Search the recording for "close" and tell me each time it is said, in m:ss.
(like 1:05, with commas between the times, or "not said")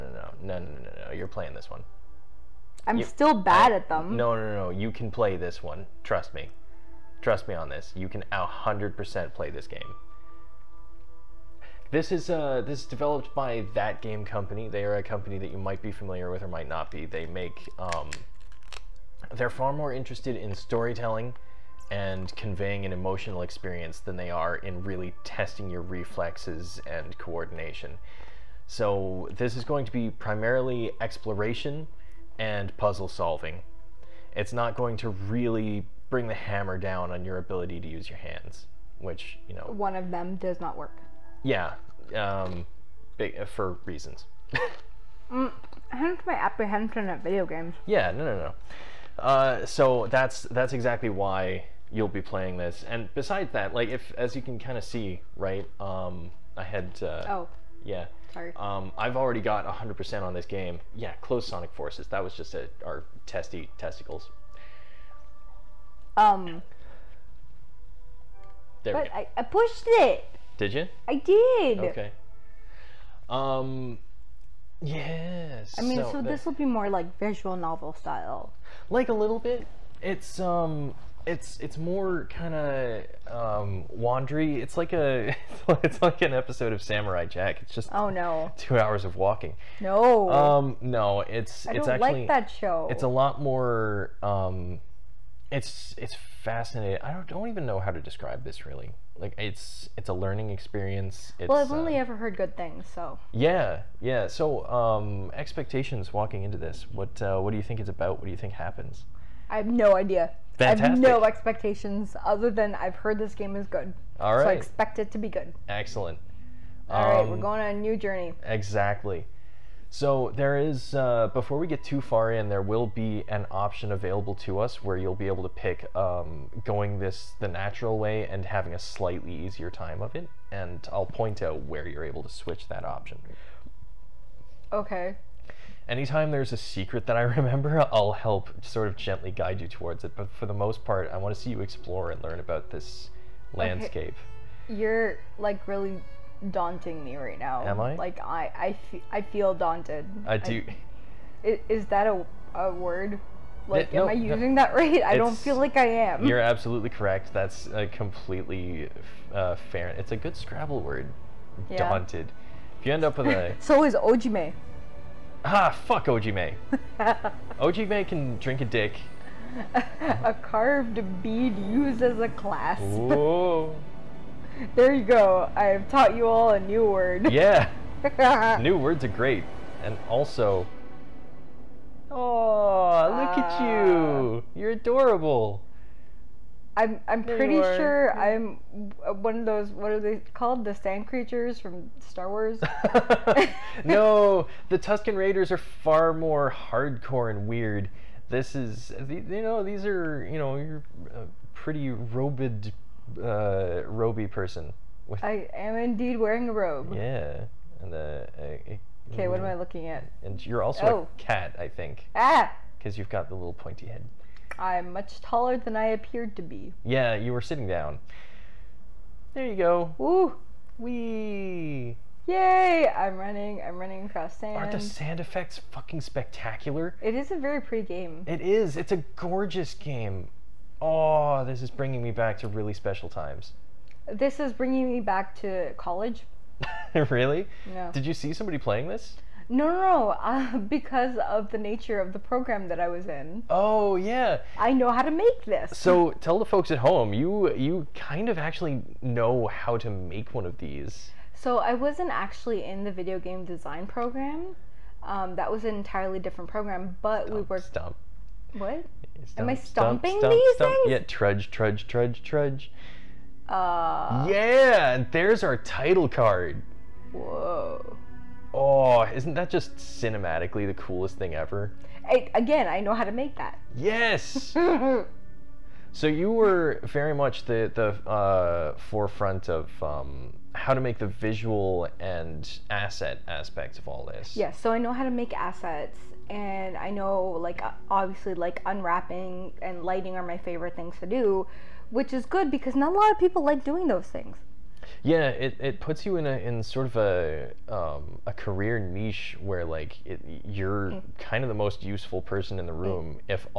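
1:01.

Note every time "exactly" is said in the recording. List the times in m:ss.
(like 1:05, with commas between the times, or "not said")
0:50, 1:58.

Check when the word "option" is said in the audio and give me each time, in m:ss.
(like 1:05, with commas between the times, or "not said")
2:03, 2:12.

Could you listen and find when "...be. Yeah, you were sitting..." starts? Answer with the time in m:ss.
3:36.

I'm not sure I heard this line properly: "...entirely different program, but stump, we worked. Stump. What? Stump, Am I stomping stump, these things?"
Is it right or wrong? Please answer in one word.
right.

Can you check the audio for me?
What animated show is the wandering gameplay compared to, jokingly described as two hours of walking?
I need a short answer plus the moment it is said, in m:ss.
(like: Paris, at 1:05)
Samurai Jack, at 1:26.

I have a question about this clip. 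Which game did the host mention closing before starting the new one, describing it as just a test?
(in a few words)
Sonic Forces.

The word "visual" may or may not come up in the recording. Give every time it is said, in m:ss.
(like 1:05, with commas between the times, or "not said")
1:17, 4:41.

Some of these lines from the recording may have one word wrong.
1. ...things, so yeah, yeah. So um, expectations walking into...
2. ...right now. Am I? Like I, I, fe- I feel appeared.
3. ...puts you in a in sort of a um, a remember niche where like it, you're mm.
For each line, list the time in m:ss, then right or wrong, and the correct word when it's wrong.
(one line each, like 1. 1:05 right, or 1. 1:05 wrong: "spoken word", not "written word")
1. 1:42 right
2. 2:27 wrong: "daunted", not "appeared"
3. 4:55 wrong: "career", not "remember".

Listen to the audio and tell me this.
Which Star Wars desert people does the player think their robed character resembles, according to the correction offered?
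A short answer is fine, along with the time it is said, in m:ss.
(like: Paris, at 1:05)
Tusken Raiders, at 3:14.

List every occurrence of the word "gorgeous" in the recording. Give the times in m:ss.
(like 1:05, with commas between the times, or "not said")
3:49.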